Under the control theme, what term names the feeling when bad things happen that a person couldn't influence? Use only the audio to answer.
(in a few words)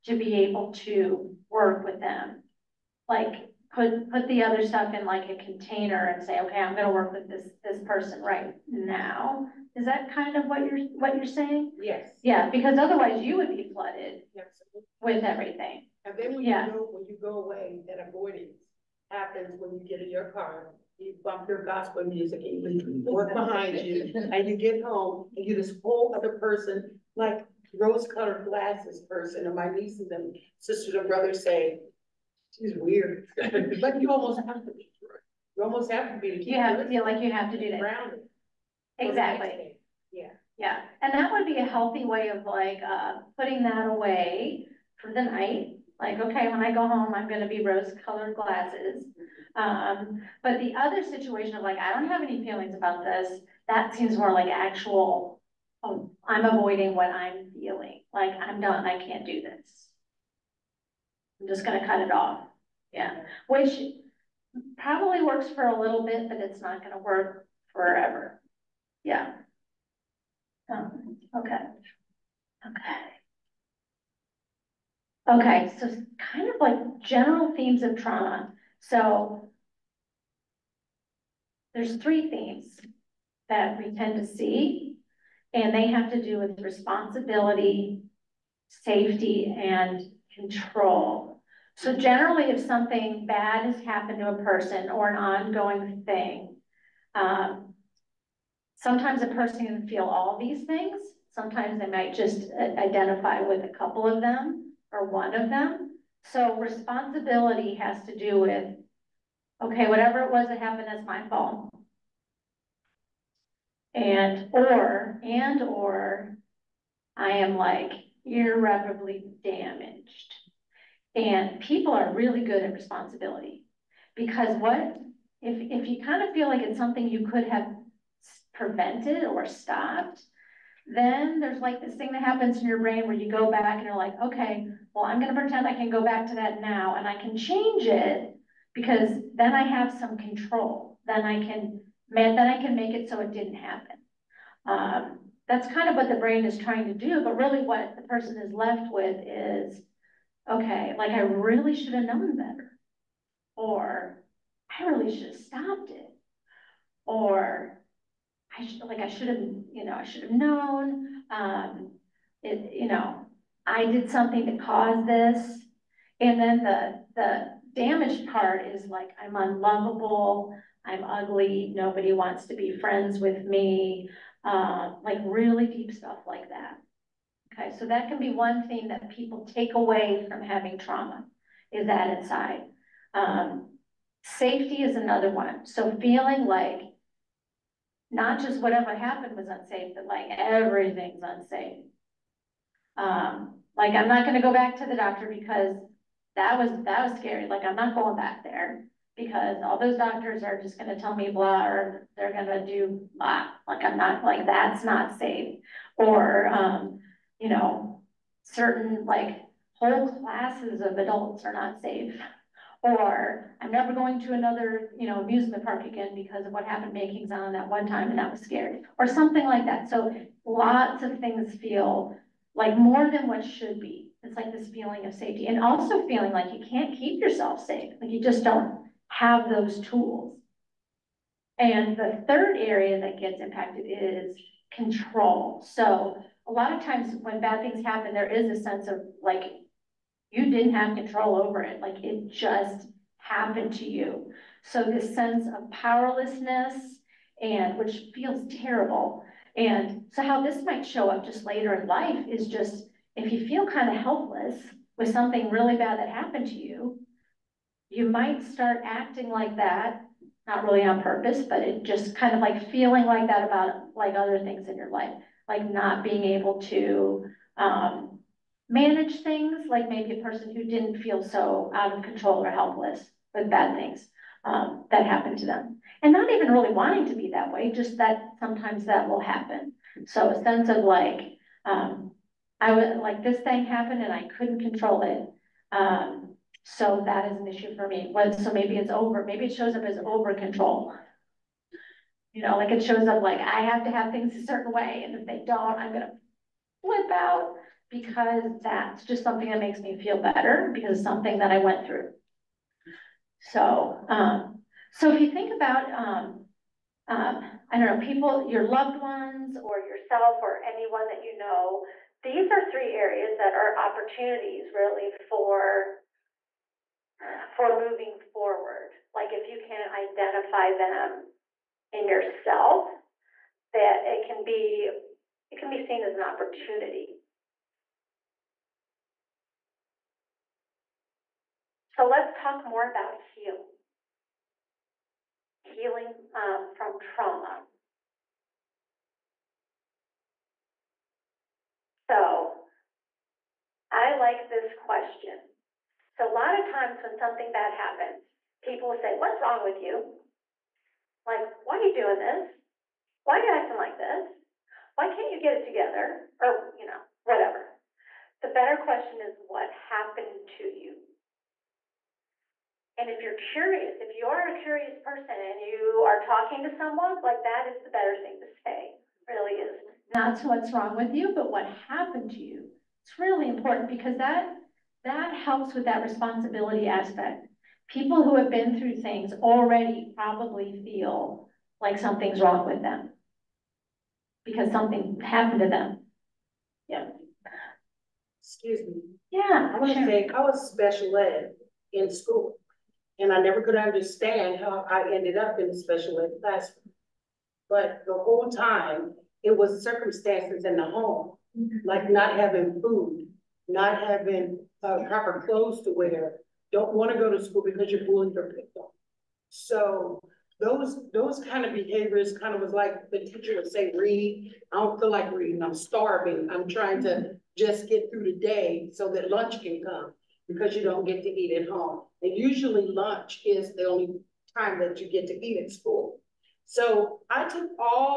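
powerlessness.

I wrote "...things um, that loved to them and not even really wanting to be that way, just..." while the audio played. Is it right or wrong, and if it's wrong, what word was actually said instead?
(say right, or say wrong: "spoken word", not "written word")
wrong: "happened", not "loved".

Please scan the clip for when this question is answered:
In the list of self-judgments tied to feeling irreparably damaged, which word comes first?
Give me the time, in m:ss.
2:49.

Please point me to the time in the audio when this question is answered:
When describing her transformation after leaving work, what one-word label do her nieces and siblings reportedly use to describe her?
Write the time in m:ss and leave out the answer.
0:32.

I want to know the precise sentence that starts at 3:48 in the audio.
Like you just don't have those tools.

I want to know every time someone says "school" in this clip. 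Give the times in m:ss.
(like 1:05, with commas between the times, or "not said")
6:32, 6:47, 7:05.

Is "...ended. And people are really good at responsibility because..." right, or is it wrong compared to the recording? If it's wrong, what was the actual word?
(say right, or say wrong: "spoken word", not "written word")
wrong: "damaged", not "ended".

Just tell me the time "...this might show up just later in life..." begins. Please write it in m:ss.
4:10.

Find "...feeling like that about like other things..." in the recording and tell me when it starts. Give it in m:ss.
4:22.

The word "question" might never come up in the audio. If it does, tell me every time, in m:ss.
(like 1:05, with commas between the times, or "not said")
5:44, 5:58.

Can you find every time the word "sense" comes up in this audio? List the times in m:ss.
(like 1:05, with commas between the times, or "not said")
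3:58, 4:05, 4:40.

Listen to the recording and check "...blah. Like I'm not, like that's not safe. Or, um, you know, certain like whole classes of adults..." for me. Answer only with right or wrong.
right.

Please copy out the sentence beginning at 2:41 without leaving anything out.
Um, it, you know, I did something to cause this.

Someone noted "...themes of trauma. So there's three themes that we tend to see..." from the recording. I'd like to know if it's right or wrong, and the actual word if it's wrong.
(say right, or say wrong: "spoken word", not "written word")
right.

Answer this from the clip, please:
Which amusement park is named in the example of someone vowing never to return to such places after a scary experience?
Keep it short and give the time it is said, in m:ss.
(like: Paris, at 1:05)
Kings Island, at 3:37.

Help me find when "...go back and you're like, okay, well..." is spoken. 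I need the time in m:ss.
2:13.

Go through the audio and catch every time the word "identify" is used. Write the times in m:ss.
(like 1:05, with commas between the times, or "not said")
1:42, 5:19.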